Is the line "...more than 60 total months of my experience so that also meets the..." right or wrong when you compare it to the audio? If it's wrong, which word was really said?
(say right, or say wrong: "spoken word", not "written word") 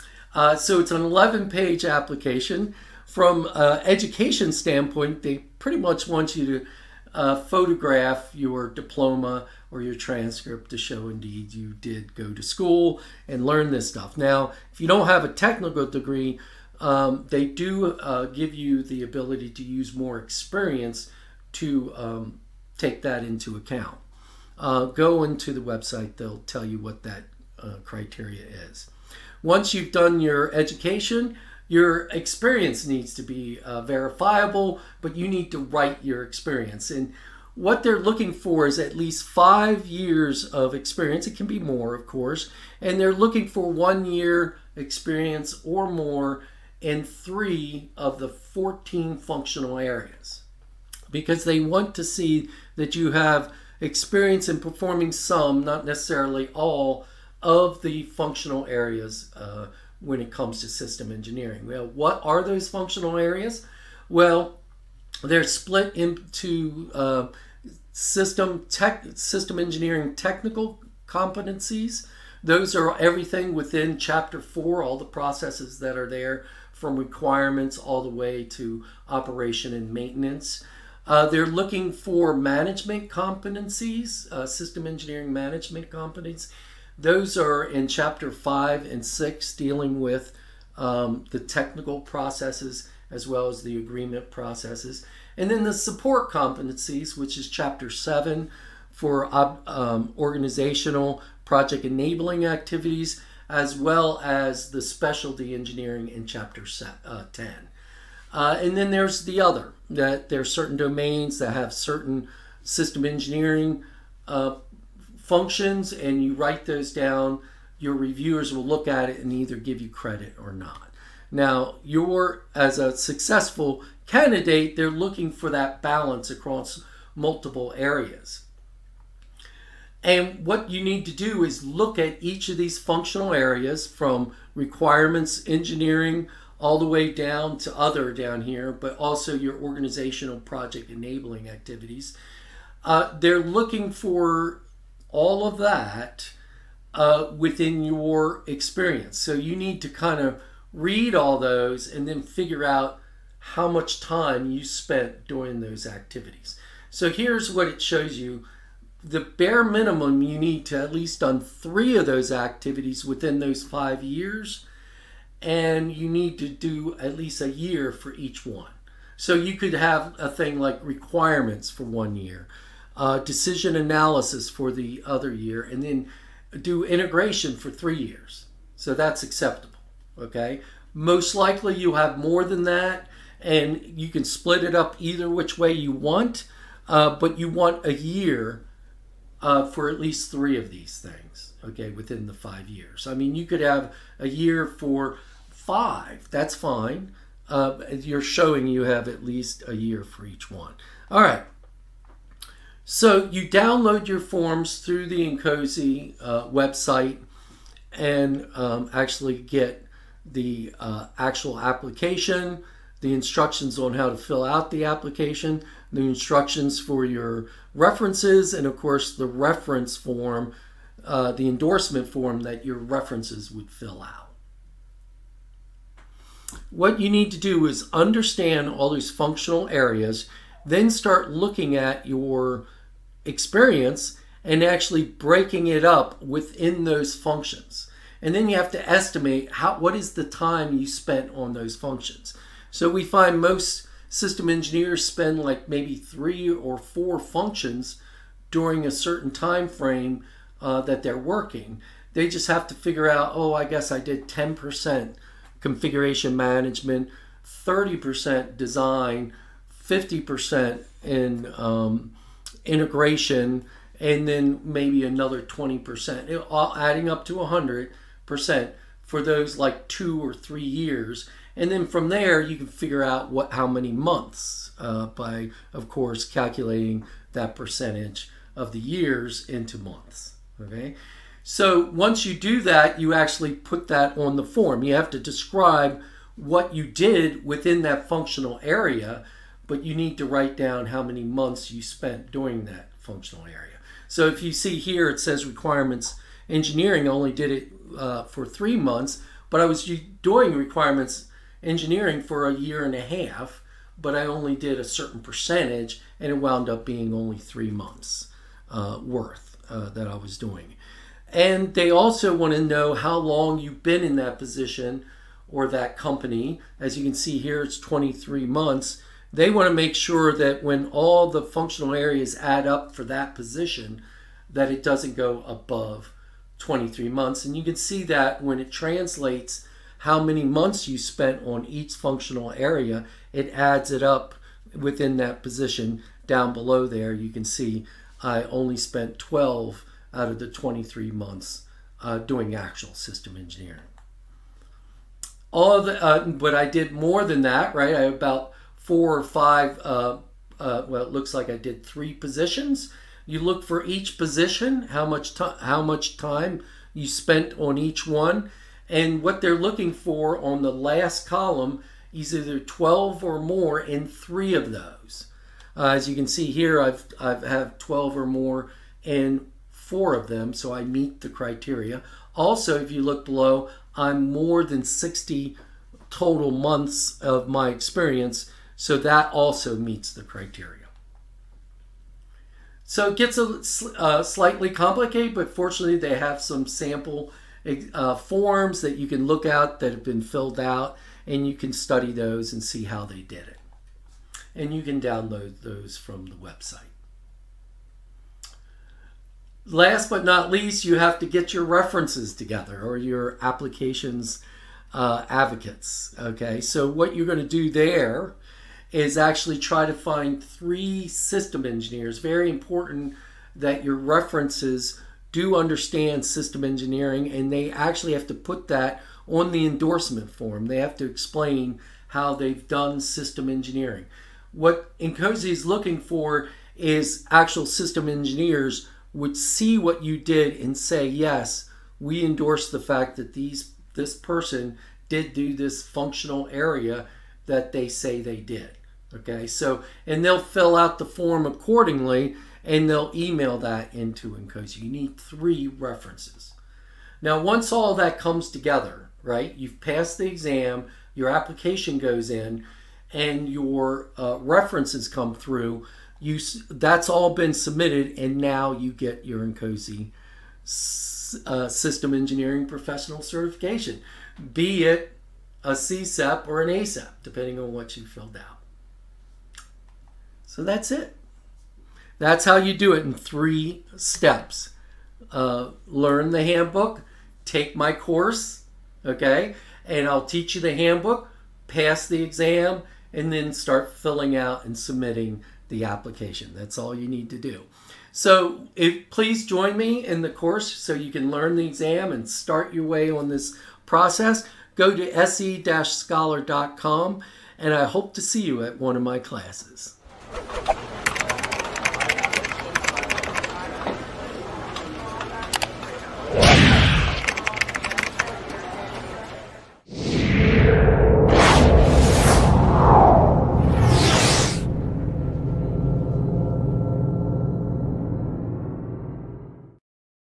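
right.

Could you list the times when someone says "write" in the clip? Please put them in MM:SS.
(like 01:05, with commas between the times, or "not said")
00:35, 01:56, 04:50.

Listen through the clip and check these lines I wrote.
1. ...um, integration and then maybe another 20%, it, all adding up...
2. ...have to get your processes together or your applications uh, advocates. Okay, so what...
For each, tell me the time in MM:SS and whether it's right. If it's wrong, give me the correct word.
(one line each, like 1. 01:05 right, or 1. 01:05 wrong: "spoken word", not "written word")
1. 04:21 right
2. 06:40 wrong: "references", not "processes".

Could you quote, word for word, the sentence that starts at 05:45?
All the, uh, but I did more than that, right?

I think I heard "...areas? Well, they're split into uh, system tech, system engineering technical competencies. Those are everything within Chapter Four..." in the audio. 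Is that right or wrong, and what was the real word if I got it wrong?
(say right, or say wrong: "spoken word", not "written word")
right.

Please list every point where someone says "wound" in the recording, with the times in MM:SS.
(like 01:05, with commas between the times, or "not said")
05:06.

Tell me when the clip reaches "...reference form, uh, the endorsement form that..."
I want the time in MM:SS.
03:39.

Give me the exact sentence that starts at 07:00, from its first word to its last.
They have to explain how they've done system engineering.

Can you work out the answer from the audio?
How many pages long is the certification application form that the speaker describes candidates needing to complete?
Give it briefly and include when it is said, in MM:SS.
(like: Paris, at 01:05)
11, at 00:01.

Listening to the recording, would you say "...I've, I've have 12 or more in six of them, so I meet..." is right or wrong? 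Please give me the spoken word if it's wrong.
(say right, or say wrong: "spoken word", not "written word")
wrong: "four", not "six".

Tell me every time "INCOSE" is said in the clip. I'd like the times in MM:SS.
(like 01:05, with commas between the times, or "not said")
03:25, 07:04, 07:24, 07:39.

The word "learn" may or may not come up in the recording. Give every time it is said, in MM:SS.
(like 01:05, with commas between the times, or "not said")
00:13, 07:55, 08:11.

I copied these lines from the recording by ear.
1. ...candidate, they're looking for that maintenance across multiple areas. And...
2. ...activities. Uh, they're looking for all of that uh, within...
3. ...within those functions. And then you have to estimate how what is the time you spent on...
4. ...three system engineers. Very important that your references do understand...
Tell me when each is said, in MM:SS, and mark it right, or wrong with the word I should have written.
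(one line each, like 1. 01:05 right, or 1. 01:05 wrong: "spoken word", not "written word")
1. 02:04 wrong: "balance", not "maintenance"
2. 02:21 right
3. 03:56 right
4. 06:50 right.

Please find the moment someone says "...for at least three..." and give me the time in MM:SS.
03:09.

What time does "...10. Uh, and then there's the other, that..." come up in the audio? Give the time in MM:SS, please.
01:47.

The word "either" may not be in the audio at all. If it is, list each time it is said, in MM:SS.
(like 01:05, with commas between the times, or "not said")
01:59, 03:04, 06:02.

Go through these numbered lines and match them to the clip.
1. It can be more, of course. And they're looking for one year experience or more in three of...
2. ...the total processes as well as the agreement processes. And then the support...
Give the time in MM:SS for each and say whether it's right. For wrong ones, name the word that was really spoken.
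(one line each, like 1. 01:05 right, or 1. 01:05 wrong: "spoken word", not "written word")
1. 00:41 right
2. 01:31 wrong: "technical", not "total".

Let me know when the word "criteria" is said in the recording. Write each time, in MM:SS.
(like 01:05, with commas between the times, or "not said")
00:27, 06:11, 06:20.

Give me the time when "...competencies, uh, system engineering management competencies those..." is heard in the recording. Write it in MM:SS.
01:23.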